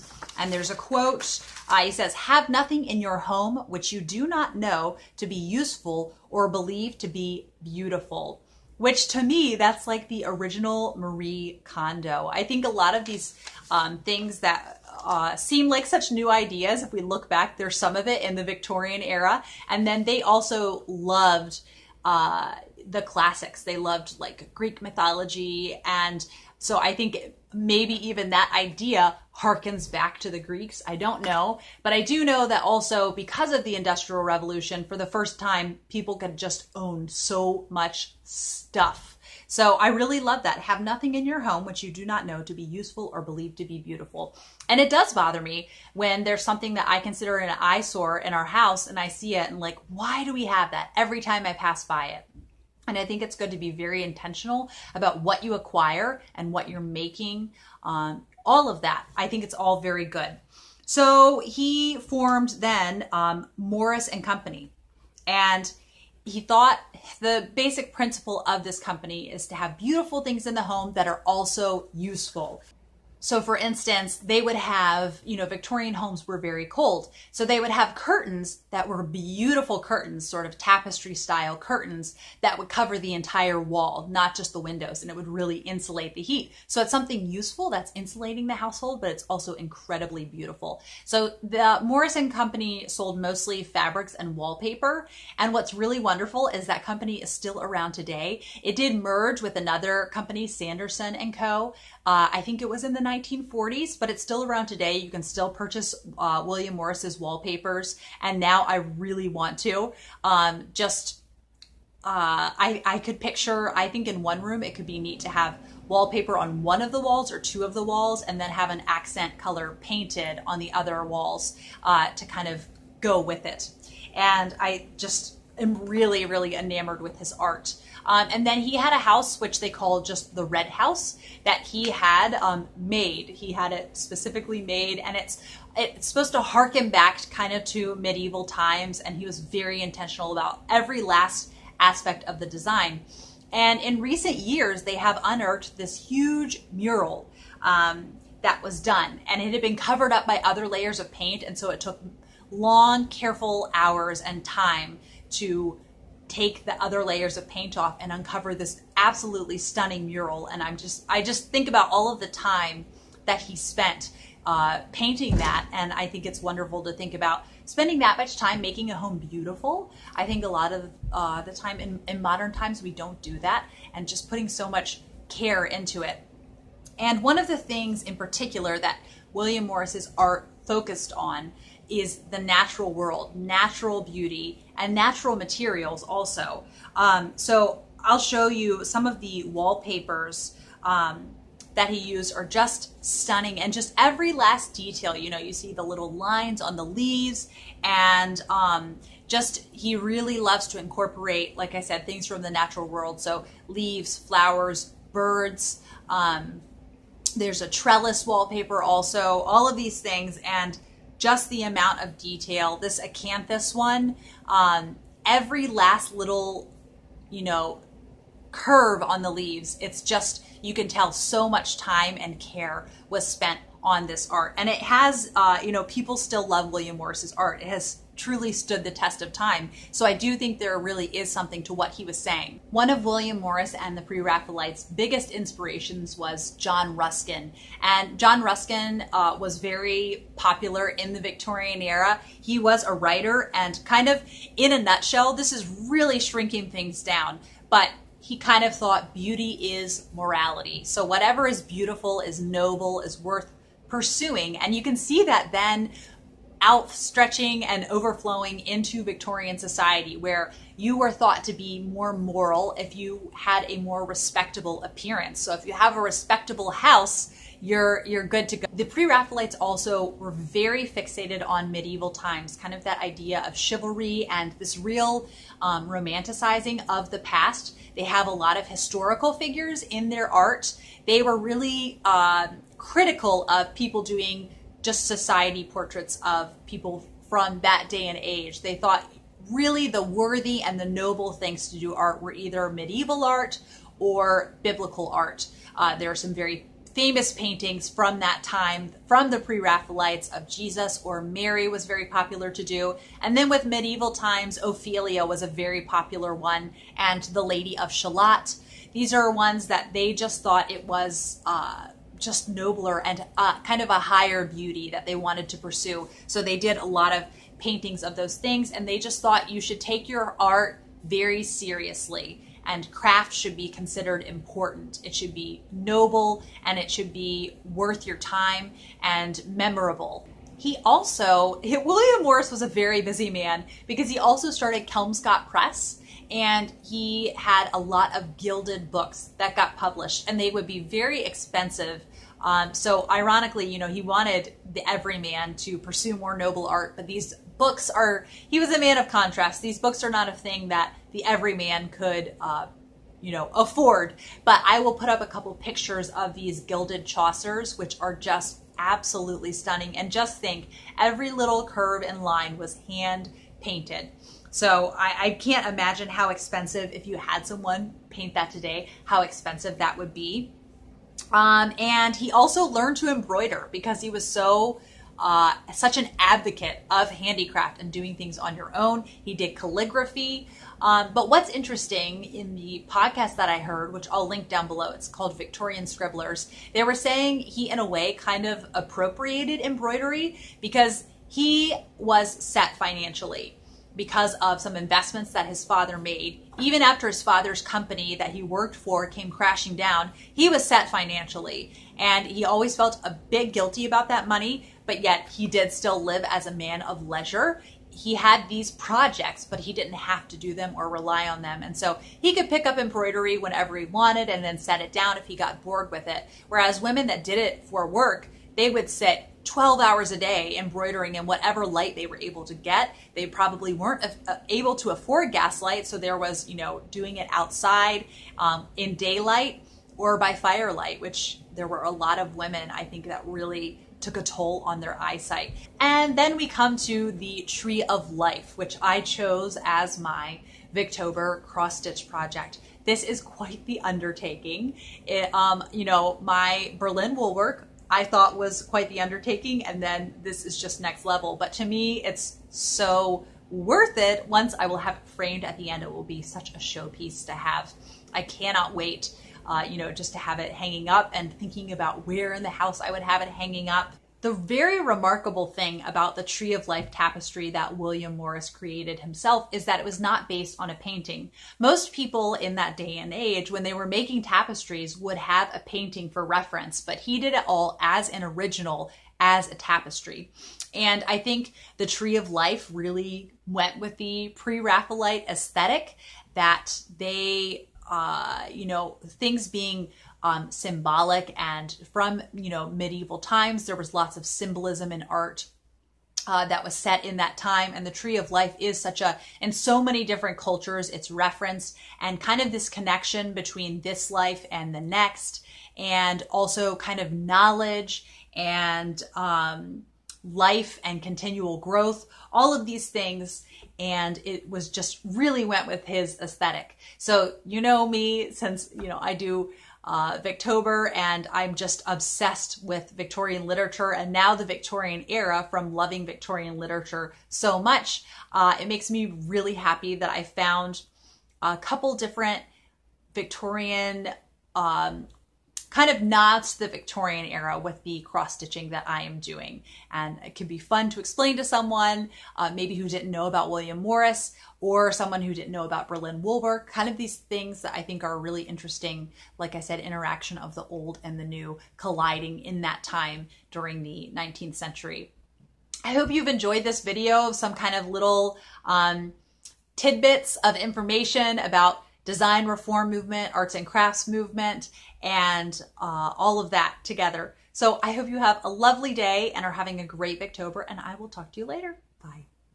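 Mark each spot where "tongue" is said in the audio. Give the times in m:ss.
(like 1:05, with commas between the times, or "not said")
not said.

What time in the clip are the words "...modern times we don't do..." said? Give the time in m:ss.
2:52.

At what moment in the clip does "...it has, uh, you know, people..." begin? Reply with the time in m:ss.
3:44.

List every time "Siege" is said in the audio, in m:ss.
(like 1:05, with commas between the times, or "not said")
not said.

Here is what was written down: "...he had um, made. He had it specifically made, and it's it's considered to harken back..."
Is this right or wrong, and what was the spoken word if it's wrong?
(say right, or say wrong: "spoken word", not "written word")
wrong: "supposed", not "considered".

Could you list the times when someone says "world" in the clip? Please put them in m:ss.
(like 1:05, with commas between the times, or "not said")
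3:02, 3:22.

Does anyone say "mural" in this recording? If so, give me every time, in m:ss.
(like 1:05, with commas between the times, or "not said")
2:26, 2:40.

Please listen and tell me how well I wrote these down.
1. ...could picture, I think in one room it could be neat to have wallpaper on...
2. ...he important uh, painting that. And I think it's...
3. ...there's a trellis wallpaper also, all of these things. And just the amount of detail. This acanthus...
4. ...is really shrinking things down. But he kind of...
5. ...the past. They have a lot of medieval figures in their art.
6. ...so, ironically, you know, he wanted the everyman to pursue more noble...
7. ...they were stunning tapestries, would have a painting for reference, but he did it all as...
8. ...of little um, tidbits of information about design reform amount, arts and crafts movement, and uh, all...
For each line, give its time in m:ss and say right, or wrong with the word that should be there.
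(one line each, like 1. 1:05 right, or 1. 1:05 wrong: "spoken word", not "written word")
1. 1:52 right
2. 2:43 wrong: "spent", not "important"
3. 3:27 right
4. 4:05 right
5. 4:37 wrong: "historical", not "medieval"
6. 5:42 right
7. 7:53 wrong: "making", not "stunning"
8. 9:17 wrong: "movement", not "amount".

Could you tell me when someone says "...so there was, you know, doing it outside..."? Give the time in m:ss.
7:05.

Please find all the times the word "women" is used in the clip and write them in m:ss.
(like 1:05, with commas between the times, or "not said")
6:56, 7:12.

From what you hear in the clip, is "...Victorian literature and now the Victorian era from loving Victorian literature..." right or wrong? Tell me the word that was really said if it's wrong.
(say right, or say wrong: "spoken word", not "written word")
right.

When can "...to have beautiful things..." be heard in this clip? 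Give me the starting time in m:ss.
1:09.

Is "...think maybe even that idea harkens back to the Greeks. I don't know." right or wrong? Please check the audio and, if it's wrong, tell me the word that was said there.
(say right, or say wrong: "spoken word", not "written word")
right.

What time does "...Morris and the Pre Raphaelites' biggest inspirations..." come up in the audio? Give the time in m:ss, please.
3:53.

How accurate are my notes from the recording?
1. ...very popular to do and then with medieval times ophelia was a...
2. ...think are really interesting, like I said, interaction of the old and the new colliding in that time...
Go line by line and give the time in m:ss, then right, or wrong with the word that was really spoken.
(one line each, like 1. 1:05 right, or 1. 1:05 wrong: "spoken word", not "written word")
1. 5:01 right
2. 9:07 right.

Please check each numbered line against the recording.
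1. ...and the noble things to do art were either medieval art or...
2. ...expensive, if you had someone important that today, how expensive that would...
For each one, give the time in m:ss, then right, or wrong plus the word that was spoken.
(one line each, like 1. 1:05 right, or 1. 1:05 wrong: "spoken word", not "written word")
1. 4:50 right
2. 6:06 wrong: "paint", not "important".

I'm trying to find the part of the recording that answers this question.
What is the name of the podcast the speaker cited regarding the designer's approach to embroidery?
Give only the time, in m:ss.
6:25.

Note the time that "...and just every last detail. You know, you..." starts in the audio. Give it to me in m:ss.
3:13.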